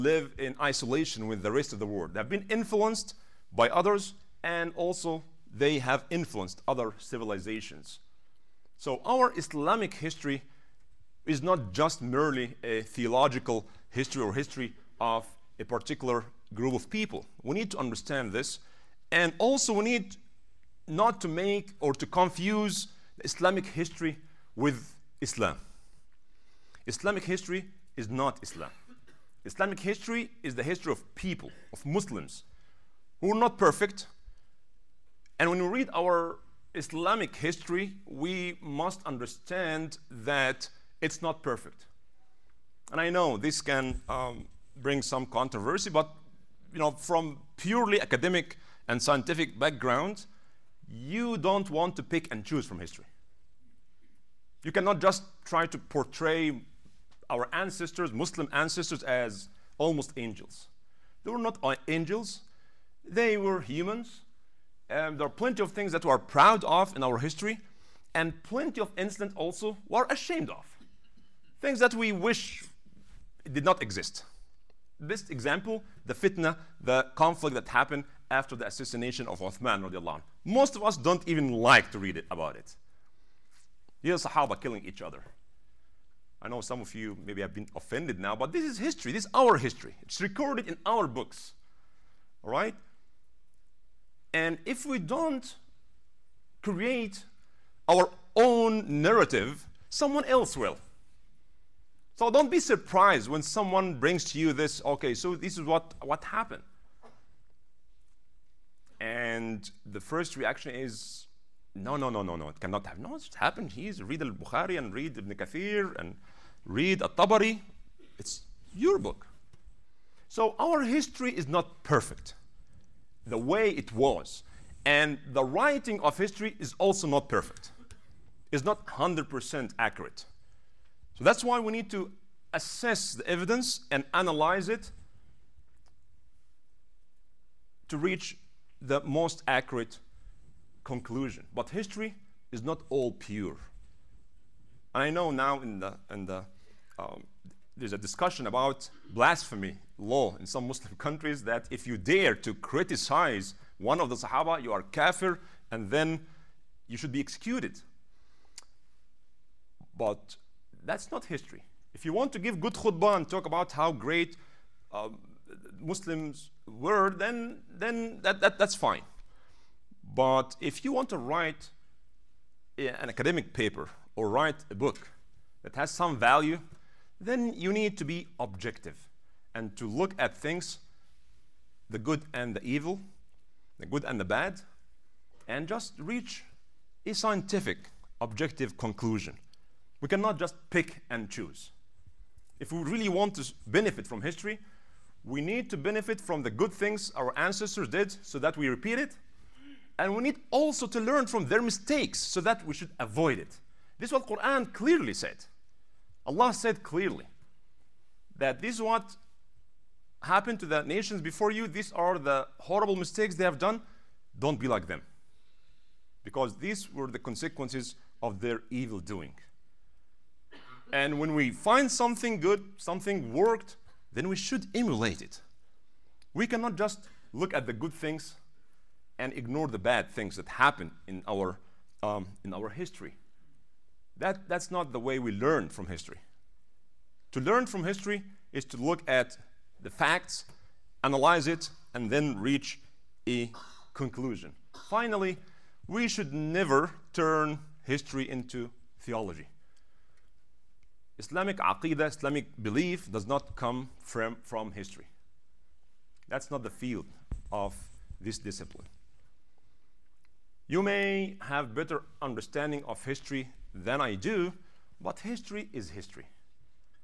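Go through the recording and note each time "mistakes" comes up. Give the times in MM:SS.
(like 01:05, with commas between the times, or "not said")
03:21, 03:32.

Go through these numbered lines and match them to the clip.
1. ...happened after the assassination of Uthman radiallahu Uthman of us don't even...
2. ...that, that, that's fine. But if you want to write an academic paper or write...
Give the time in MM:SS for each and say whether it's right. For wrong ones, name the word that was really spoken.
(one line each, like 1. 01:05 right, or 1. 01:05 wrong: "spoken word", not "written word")
1. 01:17 wrong: "Most", not "Uthman"
2. 02:48 right.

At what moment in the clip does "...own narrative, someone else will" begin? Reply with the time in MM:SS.
01:38.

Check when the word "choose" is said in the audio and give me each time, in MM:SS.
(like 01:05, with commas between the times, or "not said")
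00:52, 03:11.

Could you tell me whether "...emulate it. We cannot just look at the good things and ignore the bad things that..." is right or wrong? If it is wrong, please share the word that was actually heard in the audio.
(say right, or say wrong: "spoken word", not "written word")
right.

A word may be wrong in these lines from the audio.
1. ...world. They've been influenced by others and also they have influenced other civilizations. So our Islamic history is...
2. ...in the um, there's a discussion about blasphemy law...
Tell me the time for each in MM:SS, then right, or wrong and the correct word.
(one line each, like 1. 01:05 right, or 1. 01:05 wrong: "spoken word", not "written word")
1. 00:01 right
2. 02:26 right.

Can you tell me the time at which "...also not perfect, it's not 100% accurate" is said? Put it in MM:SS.
02:06.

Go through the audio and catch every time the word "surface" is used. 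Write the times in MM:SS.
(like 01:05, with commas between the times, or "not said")
not said.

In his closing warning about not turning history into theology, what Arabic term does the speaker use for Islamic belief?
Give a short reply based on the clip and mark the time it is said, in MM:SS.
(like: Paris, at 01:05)
aqidah, at 04:11.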